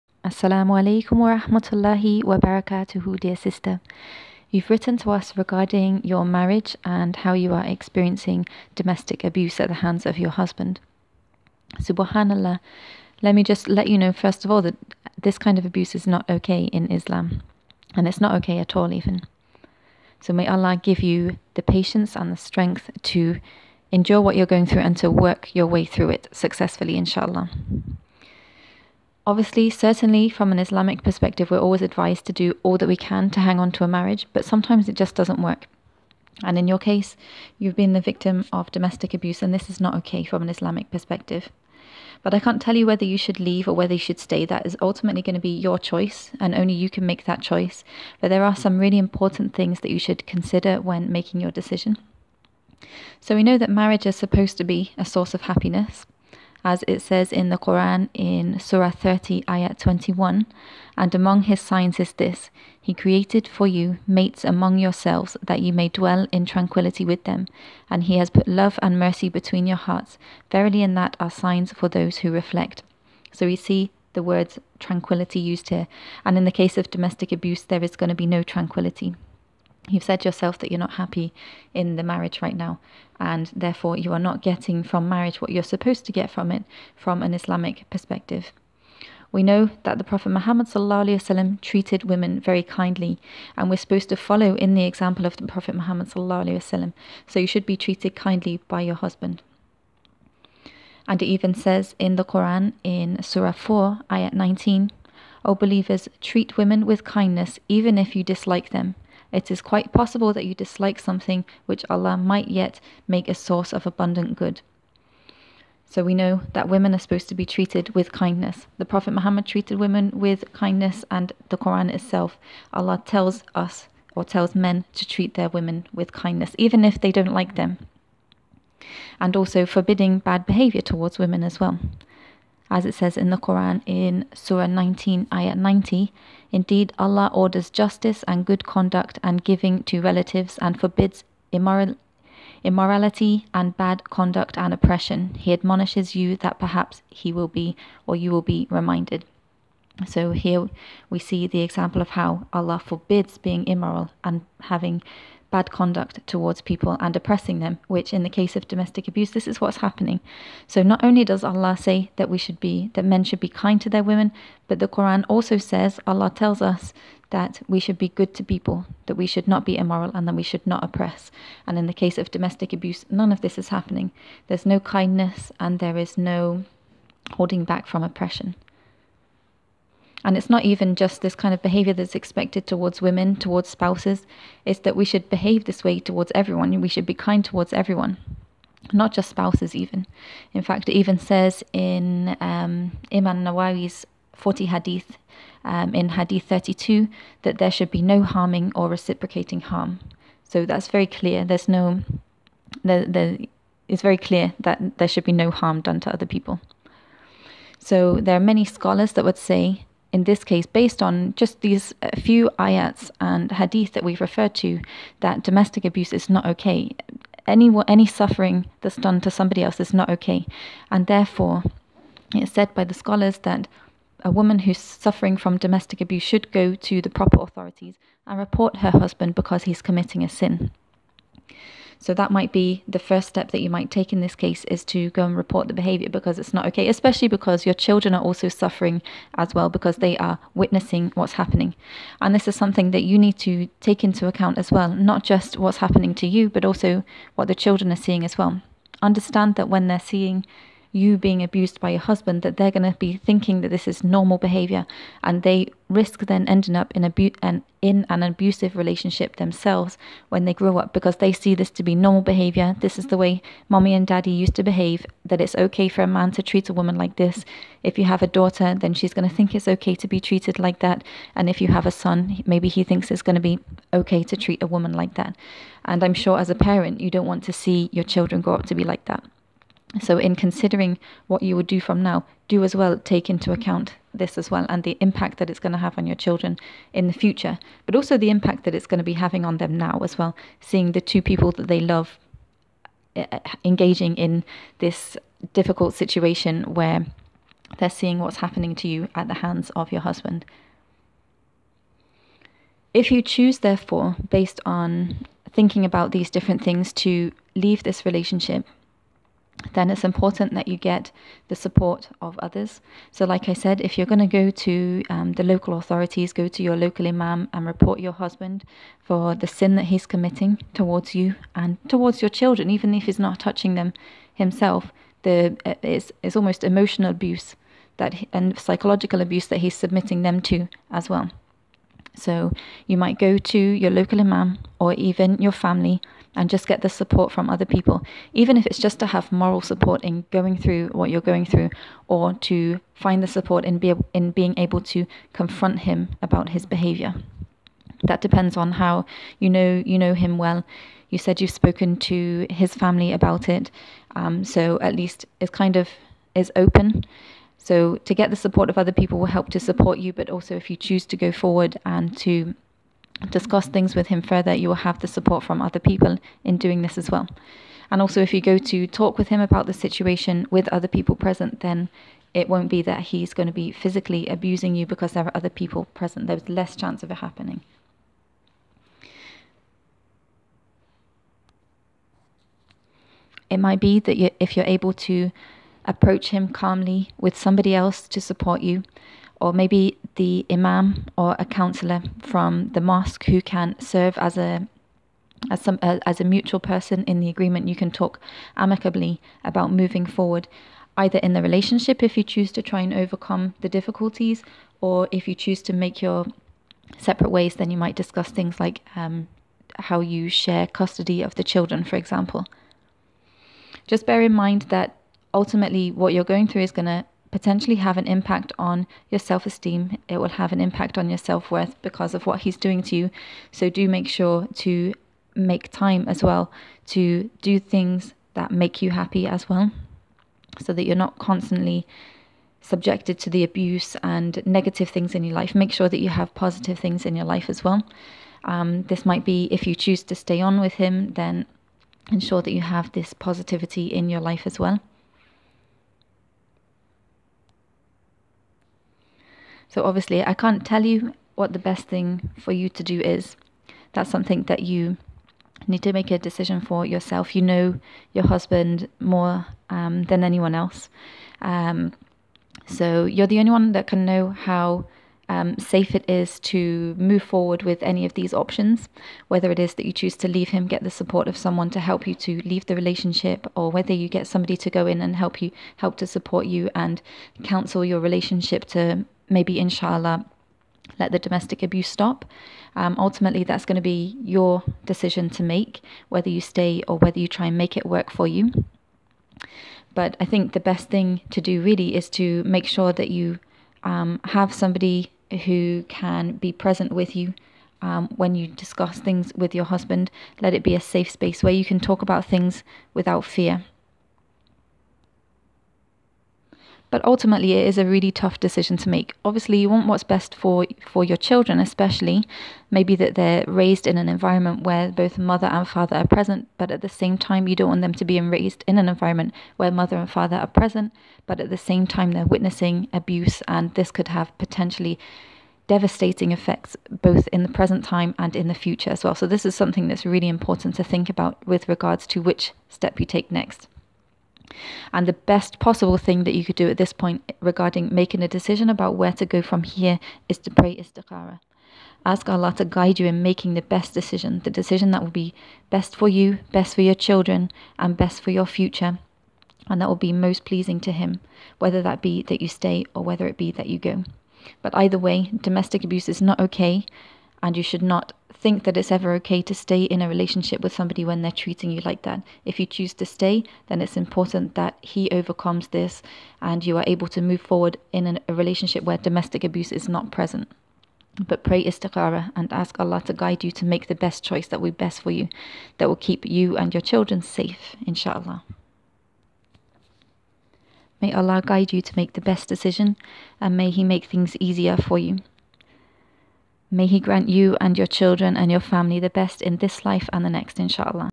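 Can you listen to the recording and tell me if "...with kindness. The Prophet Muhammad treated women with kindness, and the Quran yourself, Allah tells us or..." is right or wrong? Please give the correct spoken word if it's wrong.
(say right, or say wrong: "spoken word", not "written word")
wrong: "itself", not "yourself".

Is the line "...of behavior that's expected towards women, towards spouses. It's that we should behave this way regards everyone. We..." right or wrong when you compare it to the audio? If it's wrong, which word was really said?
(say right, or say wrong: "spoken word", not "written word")
wrong: "towards", not "regards".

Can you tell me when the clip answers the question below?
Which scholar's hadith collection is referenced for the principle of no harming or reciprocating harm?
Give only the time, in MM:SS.
03:13.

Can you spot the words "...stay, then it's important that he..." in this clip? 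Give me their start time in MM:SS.
09:23.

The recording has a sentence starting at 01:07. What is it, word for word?
And He has put love and mercy between your hearts.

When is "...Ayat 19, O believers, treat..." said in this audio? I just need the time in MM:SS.
01:44.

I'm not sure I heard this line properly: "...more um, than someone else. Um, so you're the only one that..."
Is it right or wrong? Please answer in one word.
wrong.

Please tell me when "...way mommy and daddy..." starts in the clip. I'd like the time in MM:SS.
04:23.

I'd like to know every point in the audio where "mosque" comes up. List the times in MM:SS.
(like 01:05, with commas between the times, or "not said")
06:32.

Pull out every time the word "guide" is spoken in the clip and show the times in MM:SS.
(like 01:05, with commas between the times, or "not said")
09:02, 09:33, 09:41.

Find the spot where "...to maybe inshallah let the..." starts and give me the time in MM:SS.
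07:58.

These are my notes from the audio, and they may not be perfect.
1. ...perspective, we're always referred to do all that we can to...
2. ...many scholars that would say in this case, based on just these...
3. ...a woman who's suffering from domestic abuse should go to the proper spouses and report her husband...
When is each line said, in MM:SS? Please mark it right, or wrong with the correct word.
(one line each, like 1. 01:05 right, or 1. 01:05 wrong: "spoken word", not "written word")
1. 00:31 wrong: "advised", not "referred"
2. 03:28 right
3. 03:44 wrong: "authorities", not "spouses".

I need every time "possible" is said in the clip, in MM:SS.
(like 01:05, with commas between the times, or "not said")
01:49, 08:55.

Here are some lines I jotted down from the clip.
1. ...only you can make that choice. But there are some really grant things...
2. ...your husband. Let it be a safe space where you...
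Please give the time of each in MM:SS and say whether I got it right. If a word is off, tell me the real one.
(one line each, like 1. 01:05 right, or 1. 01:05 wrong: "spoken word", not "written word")
1. 00:46 wrong: "important", not "grant"
2. 08:19 right.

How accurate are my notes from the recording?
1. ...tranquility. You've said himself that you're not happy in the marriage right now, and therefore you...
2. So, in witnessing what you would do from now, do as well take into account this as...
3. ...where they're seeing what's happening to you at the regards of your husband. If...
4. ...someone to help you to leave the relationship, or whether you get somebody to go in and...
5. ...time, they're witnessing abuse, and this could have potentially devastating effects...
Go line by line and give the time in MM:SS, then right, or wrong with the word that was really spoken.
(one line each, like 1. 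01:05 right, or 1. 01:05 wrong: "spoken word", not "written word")
1. 01:18 wrong: "yourself", not "himself"
2. 04:39 wrong: "considering", not "witnessing"
3. 04:56 wrong: "hands", not "regards"
4. 07:51 right
5. 08:41 right.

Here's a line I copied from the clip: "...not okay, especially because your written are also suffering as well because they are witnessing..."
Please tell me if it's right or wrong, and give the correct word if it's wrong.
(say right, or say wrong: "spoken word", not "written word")
wrong: "children", not "written".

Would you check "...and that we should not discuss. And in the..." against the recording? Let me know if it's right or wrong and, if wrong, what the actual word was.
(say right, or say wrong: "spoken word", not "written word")
wrong: "oppress", not "discuss".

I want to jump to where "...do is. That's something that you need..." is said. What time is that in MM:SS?
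07:32.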